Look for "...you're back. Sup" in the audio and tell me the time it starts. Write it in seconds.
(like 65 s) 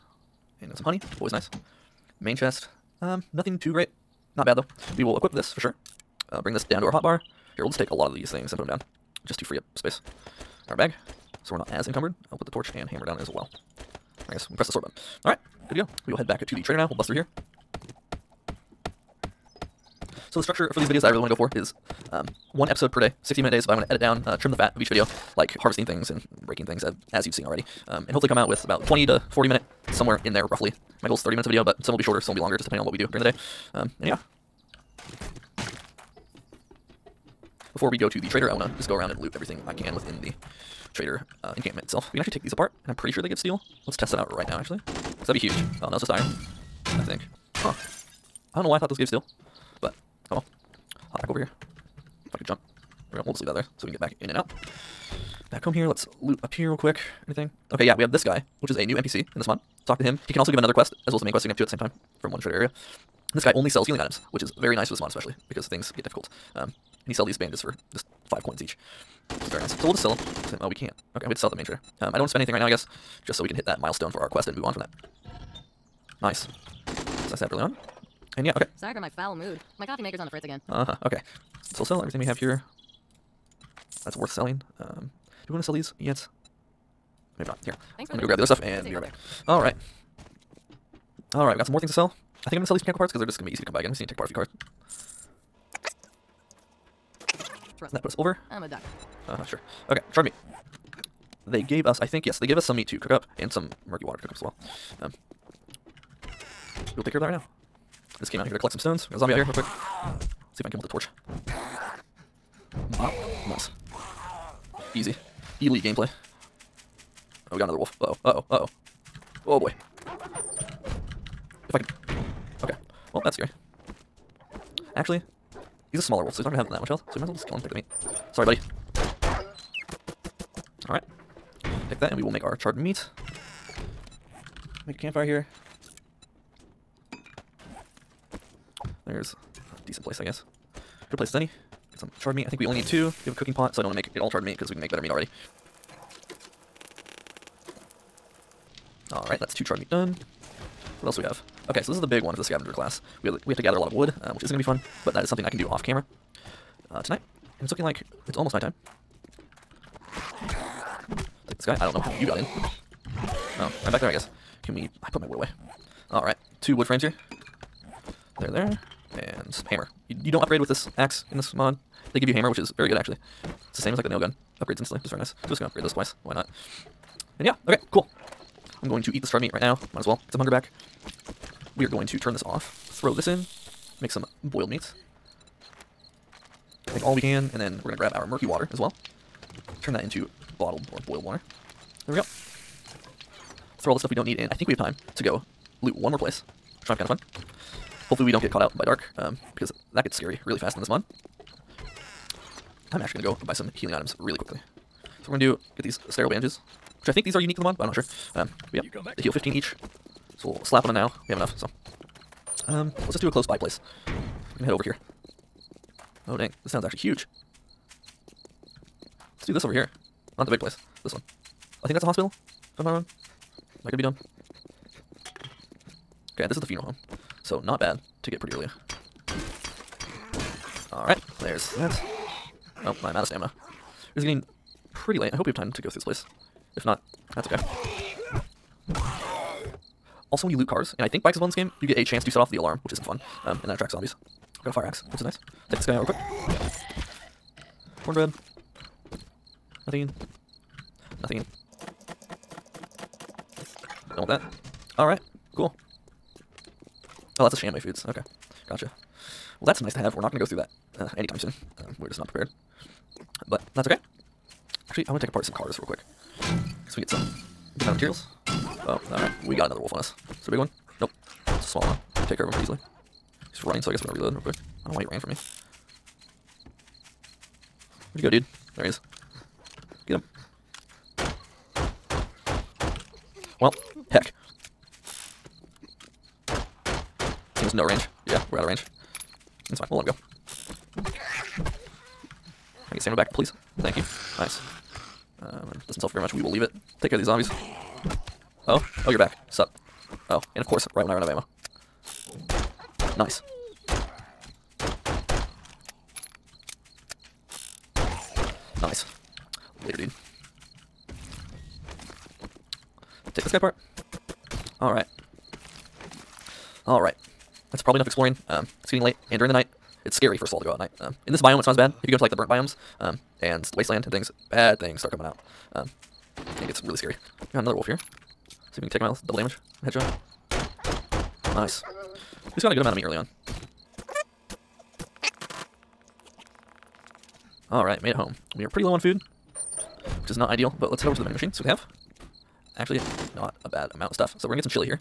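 299 s.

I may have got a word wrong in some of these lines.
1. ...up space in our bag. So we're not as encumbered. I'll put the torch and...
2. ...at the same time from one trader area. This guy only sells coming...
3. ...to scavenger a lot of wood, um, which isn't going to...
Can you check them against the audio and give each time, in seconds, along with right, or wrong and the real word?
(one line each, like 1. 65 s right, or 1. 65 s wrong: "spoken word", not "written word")
1. 9 s right
2. 61 s wrong: "healing", not "coming"
3. 153 s wrong: "gather", not "scavenger".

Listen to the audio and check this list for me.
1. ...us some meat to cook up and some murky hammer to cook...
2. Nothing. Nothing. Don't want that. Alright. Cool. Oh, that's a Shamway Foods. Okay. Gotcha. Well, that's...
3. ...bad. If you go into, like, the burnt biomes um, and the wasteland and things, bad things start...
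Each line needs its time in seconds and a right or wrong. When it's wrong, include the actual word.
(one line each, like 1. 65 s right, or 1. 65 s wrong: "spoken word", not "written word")
1. 102 s wrong: "water", not "hammer"
2. 249 s right
3. 321 s right.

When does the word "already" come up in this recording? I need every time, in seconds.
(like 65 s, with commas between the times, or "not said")
27 s, 145 s.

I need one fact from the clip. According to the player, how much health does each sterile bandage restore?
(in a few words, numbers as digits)
15.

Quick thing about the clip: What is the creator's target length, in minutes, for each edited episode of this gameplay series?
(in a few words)
30 minutes.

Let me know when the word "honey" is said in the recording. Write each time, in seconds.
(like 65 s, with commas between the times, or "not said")
0 s.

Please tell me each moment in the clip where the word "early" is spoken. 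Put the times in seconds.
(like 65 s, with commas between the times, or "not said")
77 s, 228 s, 333 s.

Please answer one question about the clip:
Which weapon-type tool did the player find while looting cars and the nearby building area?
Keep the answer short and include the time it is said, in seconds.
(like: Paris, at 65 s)
Fire axe, at 244 s.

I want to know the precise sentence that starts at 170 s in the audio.
You, you don't upgrade with this axe in this mod.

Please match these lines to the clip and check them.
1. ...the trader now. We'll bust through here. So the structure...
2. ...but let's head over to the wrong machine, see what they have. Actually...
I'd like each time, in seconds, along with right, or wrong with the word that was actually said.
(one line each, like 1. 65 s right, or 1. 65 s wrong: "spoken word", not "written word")
1. 16 s right
2. 340 s wrong: "vending", not "wrong".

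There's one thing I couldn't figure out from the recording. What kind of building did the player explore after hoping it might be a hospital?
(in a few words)
Funeral home.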